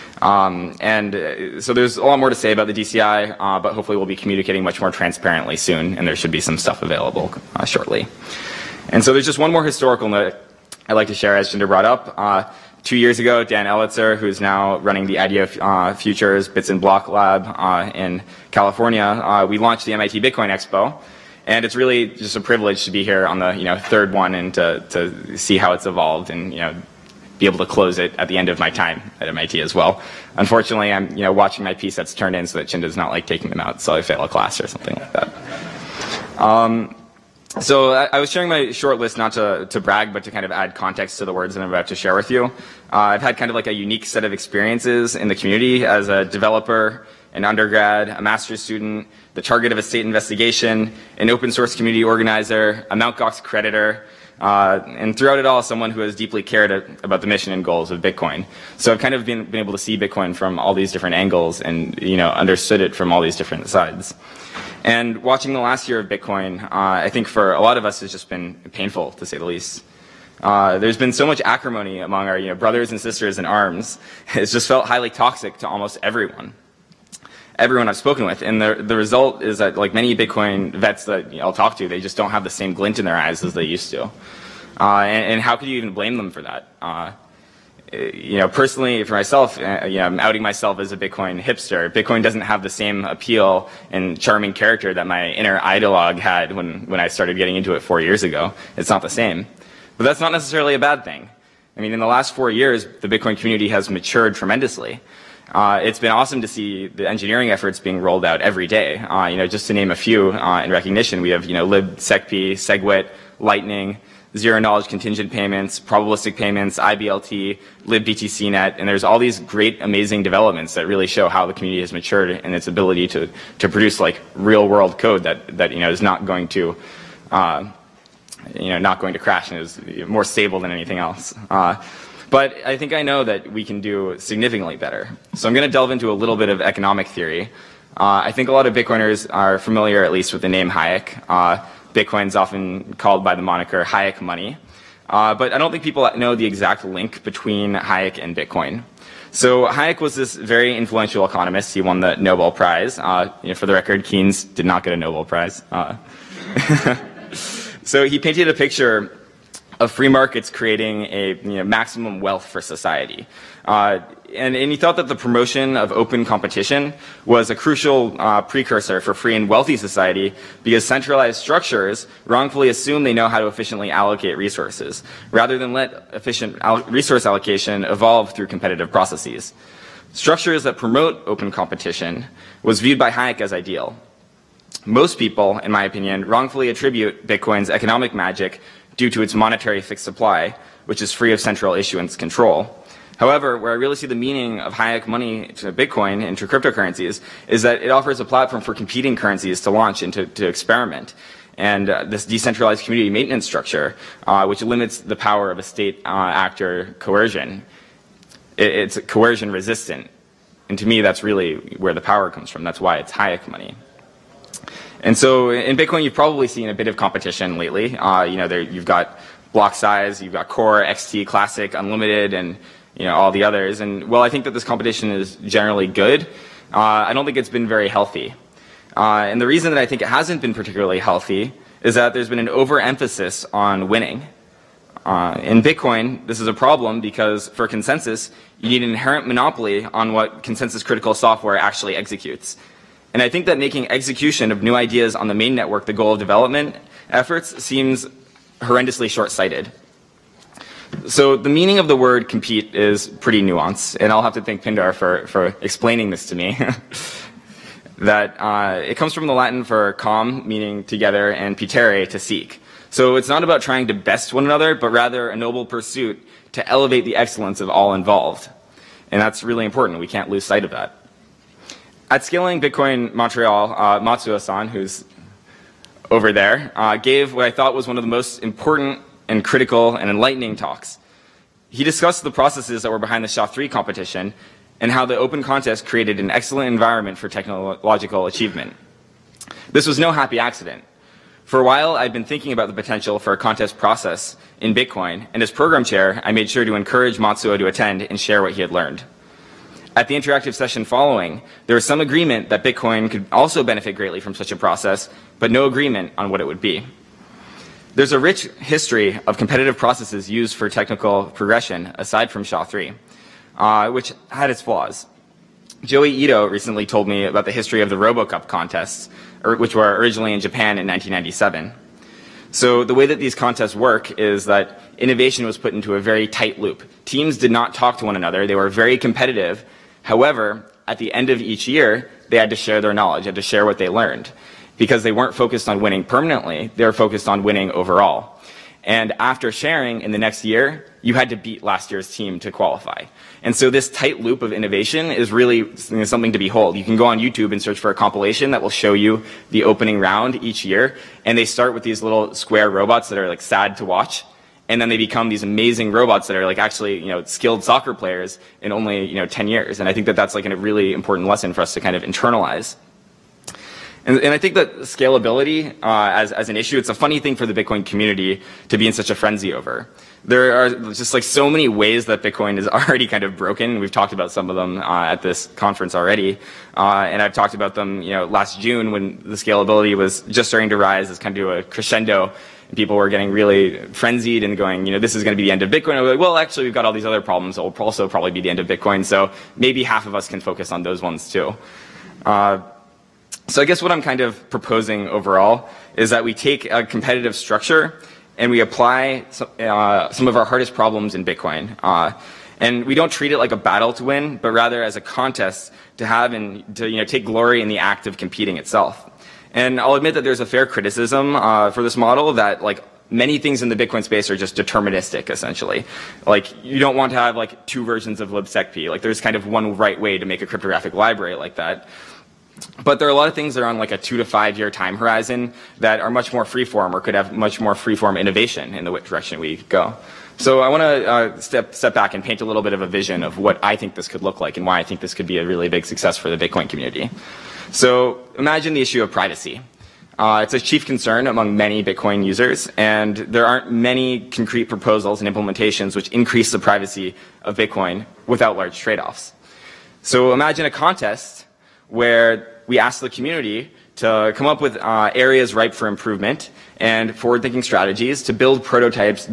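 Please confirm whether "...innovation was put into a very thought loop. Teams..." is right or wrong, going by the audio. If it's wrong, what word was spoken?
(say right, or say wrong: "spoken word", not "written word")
wrong: "tight", not "thought".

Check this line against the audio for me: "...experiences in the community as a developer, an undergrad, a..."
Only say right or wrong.
right.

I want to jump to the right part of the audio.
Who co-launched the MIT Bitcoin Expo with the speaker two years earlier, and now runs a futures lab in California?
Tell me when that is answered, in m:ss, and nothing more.
0:13.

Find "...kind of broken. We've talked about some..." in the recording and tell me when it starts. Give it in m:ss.
6:13.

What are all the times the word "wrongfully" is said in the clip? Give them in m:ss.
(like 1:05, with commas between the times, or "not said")
2:52, 3:06.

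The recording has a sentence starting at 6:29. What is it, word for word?
So maybe half of us can focus on those ones too.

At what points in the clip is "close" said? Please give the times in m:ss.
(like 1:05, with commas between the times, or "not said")
0:27.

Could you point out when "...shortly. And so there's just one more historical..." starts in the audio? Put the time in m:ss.
0:07.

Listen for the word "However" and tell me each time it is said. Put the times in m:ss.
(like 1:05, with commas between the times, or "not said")
3:13, 5:30.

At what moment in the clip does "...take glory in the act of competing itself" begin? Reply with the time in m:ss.
6:47.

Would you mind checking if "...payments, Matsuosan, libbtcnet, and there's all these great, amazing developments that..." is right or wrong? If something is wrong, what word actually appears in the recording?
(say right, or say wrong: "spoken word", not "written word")
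wrong: "IBLT", not "Matsuosan".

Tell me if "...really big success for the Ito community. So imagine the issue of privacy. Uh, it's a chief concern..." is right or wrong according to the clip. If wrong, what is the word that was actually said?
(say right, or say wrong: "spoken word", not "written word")
wrong: "Bitcoin", not "Ito".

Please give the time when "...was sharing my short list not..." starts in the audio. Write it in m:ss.
0:38.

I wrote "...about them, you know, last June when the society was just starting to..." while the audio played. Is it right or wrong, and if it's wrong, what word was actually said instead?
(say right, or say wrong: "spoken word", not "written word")
wrong: "scalability", not "society".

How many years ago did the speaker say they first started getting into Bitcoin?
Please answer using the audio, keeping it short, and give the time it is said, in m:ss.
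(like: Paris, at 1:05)
4, at 1:37.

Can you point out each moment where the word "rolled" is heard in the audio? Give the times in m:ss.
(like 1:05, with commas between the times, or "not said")
1:47.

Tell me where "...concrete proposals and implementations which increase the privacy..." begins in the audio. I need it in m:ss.
7:24.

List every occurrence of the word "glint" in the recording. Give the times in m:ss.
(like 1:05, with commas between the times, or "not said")
1:22.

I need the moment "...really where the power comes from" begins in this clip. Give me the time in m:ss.
3:31.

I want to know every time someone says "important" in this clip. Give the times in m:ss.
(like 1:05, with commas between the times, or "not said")
4:29, 4:38, 6:00.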